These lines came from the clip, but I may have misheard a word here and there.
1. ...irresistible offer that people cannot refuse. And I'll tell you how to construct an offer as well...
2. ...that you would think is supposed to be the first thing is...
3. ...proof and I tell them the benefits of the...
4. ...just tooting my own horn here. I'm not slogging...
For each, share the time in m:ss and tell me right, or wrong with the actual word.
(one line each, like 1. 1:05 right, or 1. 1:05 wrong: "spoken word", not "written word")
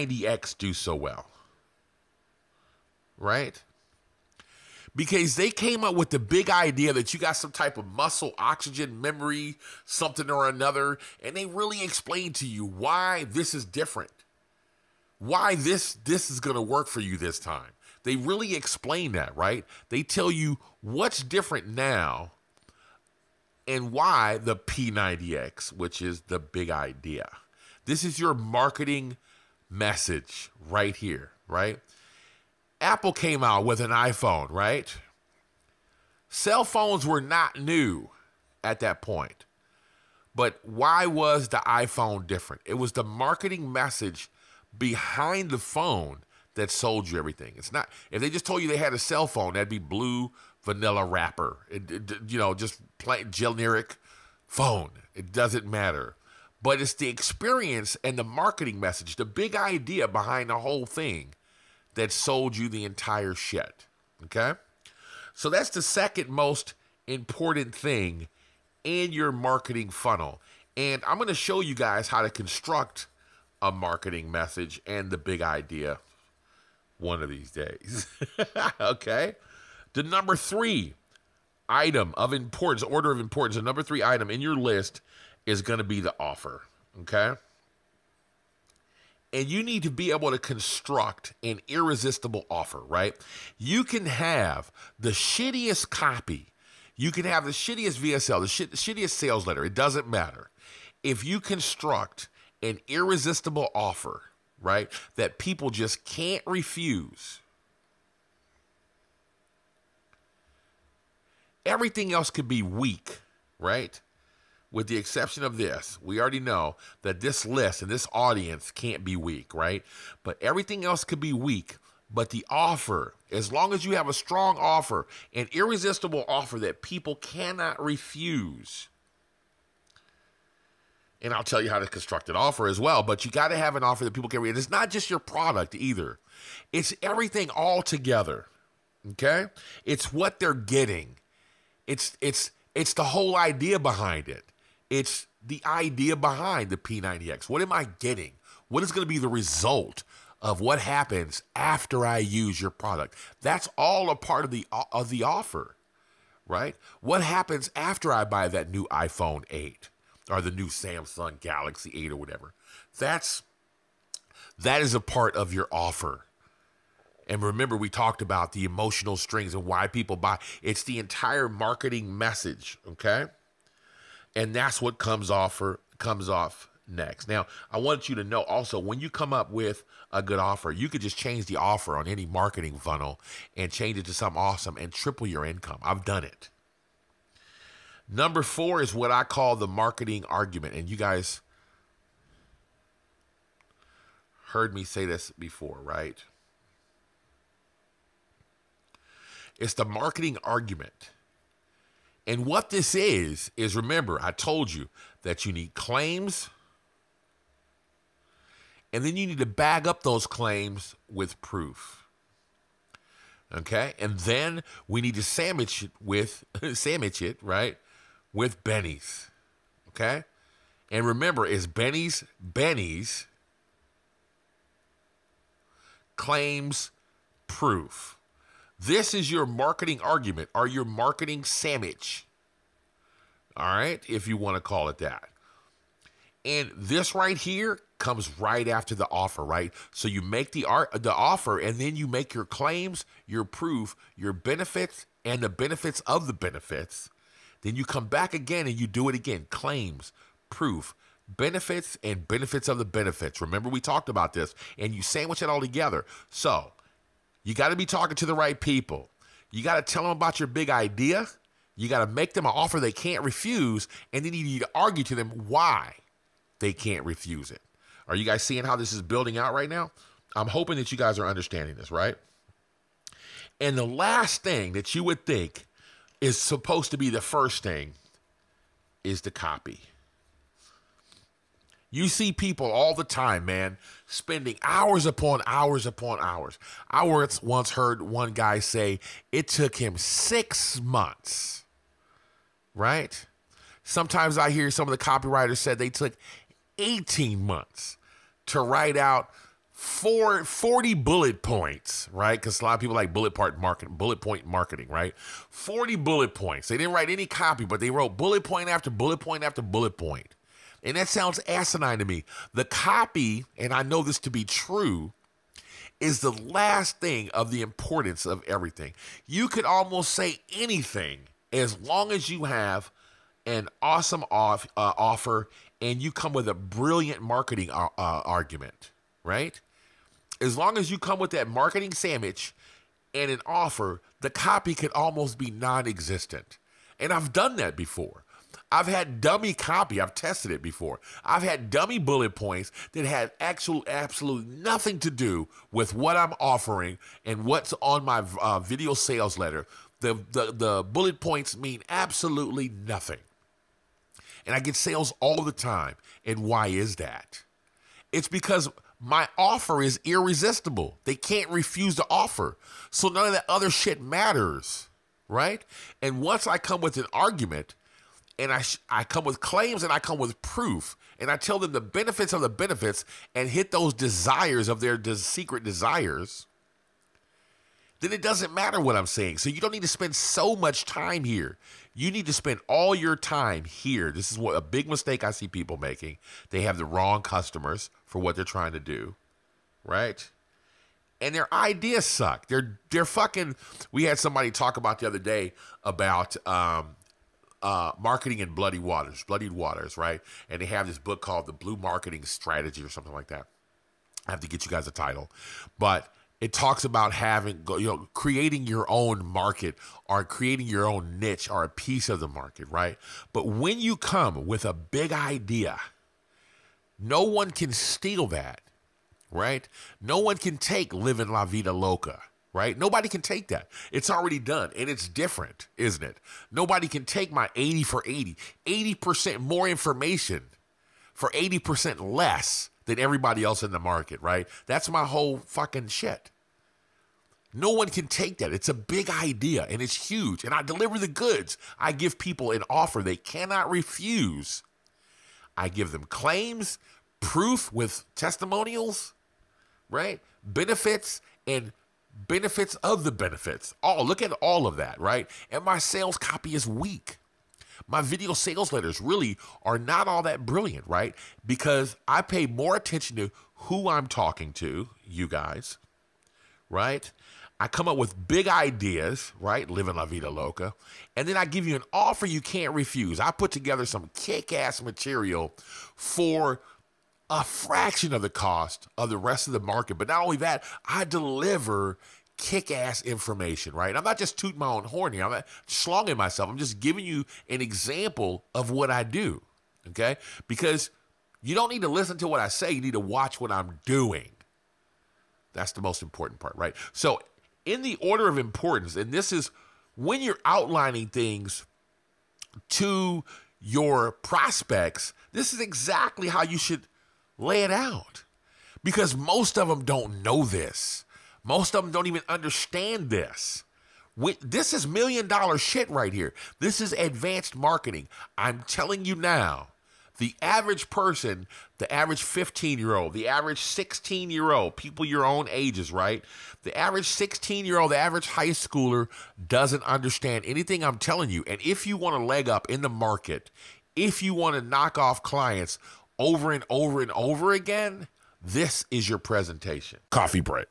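1. 2:05 right
2. 4:34 right
3. 6:10 right
4. 8:04 right.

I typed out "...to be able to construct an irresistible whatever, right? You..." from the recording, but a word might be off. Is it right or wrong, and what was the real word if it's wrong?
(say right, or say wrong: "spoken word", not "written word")
wrong: "offer", not "whatever".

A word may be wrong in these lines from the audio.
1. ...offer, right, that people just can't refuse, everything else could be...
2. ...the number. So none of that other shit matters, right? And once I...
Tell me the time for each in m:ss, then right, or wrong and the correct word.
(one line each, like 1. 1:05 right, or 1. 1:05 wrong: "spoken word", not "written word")
1. 1:43 right
2. 6:01 wrong: "offer", not "number".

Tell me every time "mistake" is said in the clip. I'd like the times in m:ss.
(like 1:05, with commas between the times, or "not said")
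6:24.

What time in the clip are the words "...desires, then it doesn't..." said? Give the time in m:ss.
6:15.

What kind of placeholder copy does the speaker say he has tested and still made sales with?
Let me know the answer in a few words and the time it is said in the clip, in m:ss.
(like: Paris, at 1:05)
dummy copy, at 5:39.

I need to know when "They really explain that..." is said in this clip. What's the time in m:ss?
0:18.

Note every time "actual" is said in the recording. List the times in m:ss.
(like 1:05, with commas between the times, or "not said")
5:43.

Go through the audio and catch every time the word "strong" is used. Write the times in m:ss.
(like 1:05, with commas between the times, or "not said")
2:04.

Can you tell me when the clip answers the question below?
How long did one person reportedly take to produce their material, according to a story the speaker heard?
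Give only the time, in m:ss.
4:49.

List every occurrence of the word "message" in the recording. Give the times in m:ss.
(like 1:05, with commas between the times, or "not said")
0:29, 0:43, 0:58, 1:14, 2:52.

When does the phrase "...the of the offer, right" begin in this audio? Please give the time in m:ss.
2:34.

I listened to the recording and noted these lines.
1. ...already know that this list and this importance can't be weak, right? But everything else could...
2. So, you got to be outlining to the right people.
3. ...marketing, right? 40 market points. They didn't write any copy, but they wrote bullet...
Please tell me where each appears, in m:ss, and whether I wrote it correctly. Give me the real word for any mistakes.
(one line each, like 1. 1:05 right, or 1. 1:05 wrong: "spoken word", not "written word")
1. 1:56 wrong: "audience", not "importance"
2. 4:16 wrong: "talking", not "outlining"
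3. 5:04 wrong: "bullet", not "market".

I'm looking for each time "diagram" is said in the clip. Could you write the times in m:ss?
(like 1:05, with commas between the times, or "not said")
not said.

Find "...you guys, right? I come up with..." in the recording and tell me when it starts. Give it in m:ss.
7:45.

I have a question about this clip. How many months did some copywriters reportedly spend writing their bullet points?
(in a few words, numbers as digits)
18.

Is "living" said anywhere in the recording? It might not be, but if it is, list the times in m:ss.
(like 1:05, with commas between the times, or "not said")
7:00, 7:49.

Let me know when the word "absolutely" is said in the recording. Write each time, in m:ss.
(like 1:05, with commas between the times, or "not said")
5:43, 5:51.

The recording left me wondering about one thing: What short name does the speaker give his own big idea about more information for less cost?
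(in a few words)
80 for 80.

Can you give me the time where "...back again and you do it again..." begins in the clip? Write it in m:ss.
4:08.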